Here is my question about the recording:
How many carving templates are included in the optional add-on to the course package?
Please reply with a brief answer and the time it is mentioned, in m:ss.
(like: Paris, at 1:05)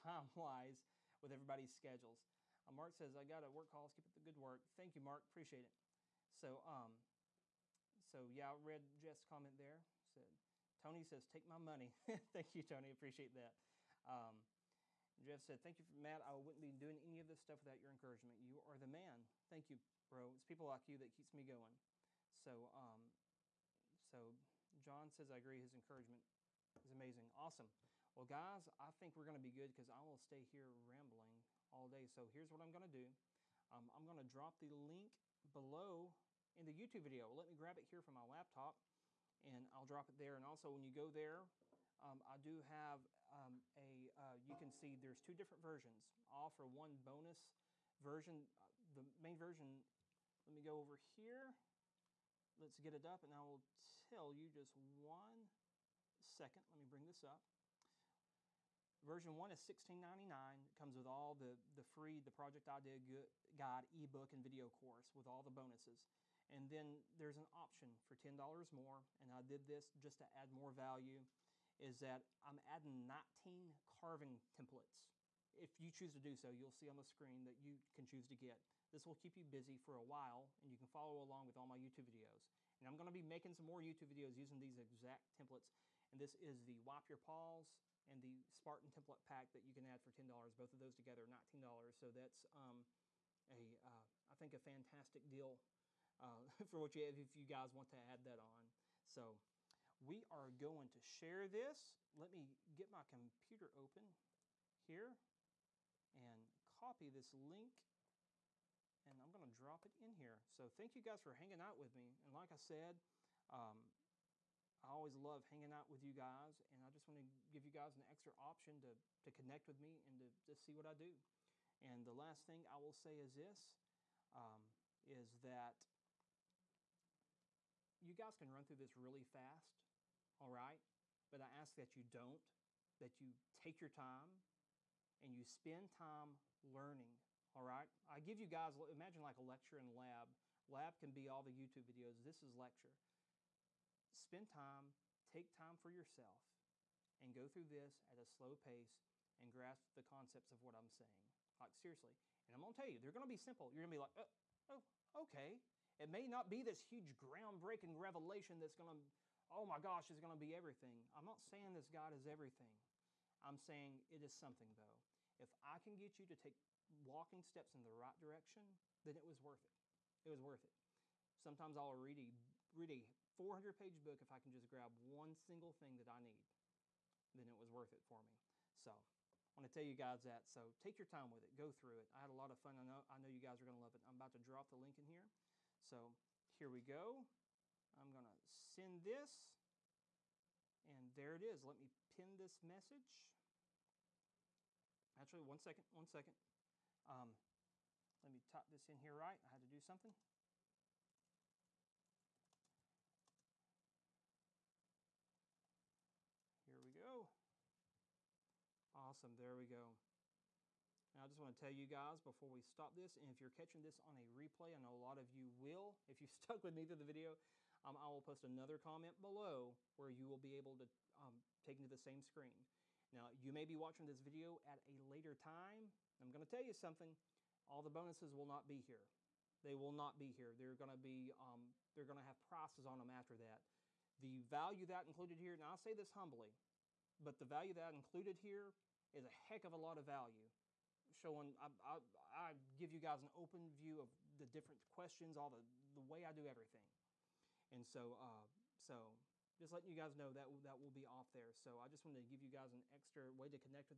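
19, at 1:13.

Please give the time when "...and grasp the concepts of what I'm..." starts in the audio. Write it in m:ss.
2:29.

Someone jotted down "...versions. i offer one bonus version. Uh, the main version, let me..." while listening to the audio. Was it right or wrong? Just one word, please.
right.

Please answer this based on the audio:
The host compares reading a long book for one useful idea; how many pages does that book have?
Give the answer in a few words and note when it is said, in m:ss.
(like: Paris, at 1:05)
400, at 2:53.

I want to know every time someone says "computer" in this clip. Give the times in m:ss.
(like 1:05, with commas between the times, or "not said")
1:43.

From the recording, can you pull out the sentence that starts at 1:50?
So thank you guys for hanging out with me.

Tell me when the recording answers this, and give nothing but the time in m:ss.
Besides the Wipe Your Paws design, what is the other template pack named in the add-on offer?
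1:28.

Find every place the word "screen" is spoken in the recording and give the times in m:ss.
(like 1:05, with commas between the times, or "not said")
1:17, 3:42.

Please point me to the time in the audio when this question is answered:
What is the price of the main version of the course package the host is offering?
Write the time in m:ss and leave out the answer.
0:59.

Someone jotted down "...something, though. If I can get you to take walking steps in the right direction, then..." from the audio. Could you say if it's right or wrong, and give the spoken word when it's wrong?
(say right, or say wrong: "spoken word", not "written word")
right.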